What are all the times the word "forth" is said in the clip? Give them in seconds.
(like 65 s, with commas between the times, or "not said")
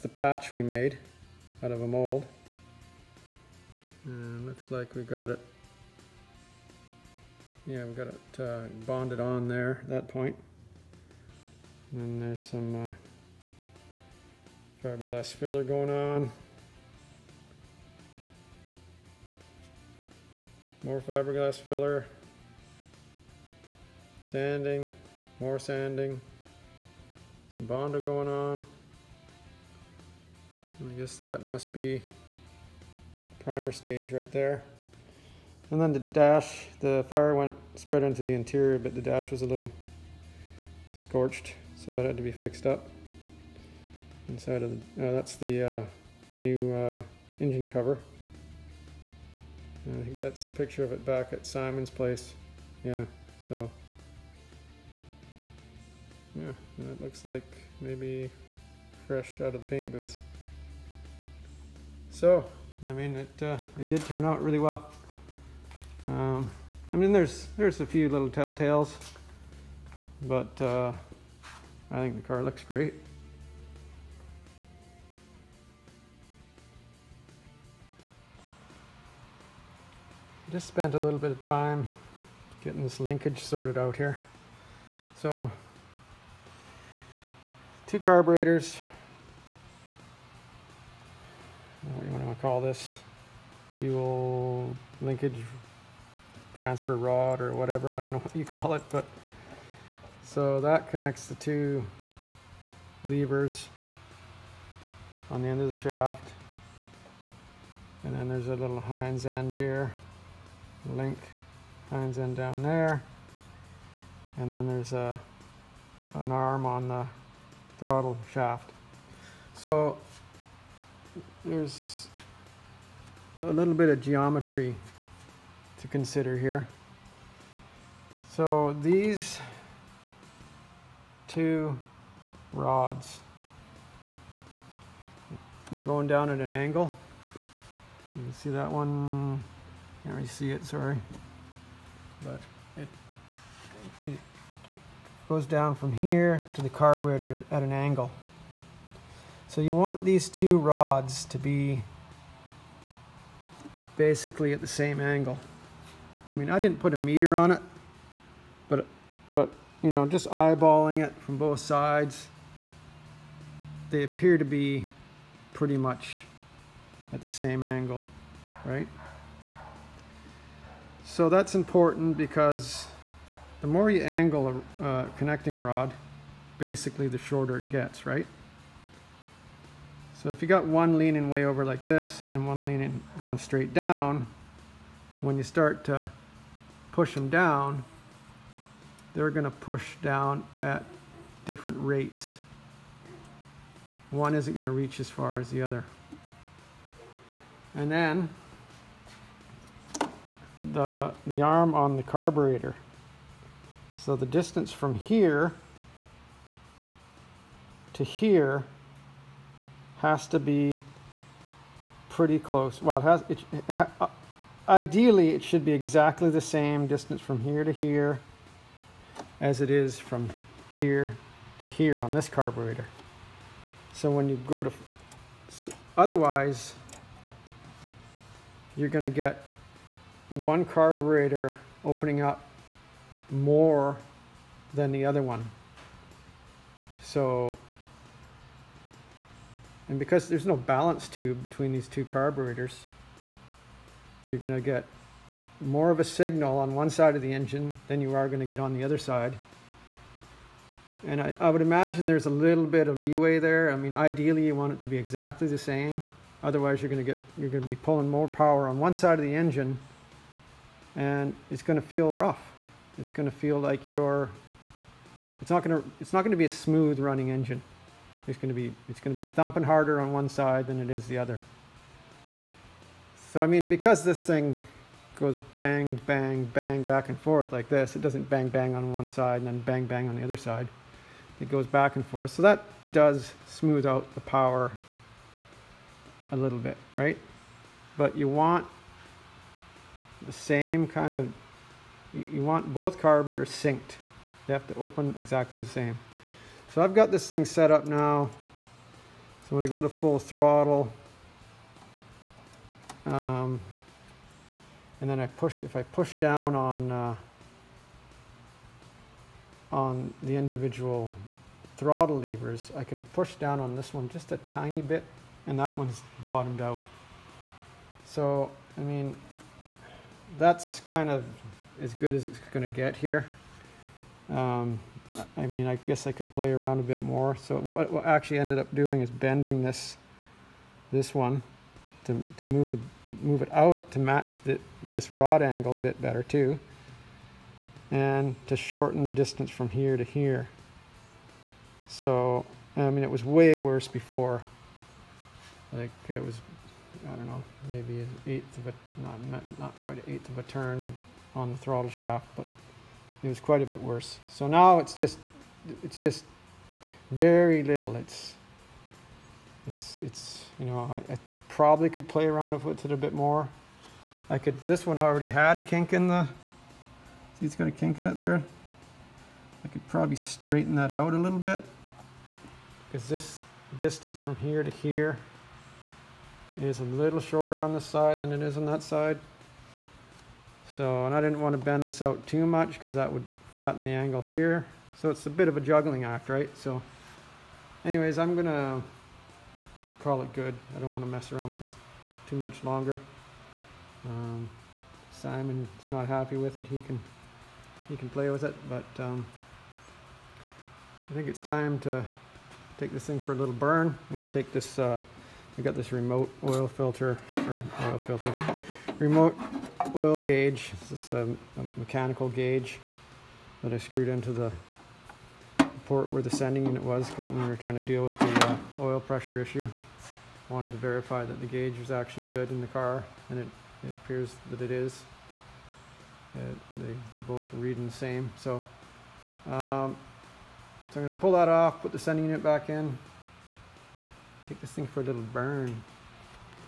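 277 s, 282 s.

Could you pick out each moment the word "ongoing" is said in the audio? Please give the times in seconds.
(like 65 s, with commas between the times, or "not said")
not said.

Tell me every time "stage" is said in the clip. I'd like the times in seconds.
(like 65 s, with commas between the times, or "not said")
33 s.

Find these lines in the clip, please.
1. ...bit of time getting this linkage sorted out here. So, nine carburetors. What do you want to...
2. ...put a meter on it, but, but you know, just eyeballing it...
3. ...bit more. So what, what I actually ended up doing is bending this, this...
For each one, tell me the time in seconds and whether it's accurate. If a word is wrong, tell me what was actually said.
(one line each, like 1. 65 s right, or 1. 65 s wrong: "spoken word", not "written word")
1. 81 s wrong: "two", not "nine"
2. 156 s right
3. 326 s right.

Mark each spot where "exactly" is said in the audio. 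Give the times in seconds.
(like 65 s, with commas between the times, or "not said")
215 s, 254 s, 295 s.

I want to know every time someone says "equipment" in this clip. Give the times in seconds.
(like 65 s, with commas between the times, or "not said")
not said.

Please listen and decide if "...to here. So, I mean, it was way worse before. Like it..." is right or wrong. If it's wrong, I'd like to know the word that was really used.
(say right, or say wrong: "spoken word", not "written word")
right.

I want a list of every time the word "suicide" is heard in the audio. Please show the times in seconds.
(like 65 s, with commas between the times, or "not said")
not said.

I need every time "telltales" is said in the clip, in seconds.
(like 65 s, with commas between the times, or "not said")
68 s.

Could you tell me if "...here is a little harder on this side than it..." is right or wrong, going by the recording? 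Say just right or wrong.
wrong.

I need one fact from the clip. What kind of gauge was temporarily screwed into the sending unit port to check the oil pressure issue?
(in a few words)
Mechanical gauge.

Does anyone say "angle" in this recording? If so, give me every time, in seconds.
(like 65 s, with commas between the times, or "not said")
136 s, 147 s, 155 s, 167 s, 174 s, 335 s, 383 s.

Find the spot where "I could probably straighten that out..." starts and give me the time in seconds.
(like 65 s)
369 s.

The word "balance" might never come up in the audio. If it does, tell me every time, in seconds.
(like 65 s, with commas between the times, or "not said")
240 s.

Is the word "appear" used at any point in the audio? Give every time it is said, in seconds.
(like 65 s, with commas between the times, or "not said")
164 s, 424 s.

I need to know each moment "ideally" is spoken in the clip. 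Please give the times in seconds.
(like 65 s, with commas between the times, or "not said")
214 s, 253 s.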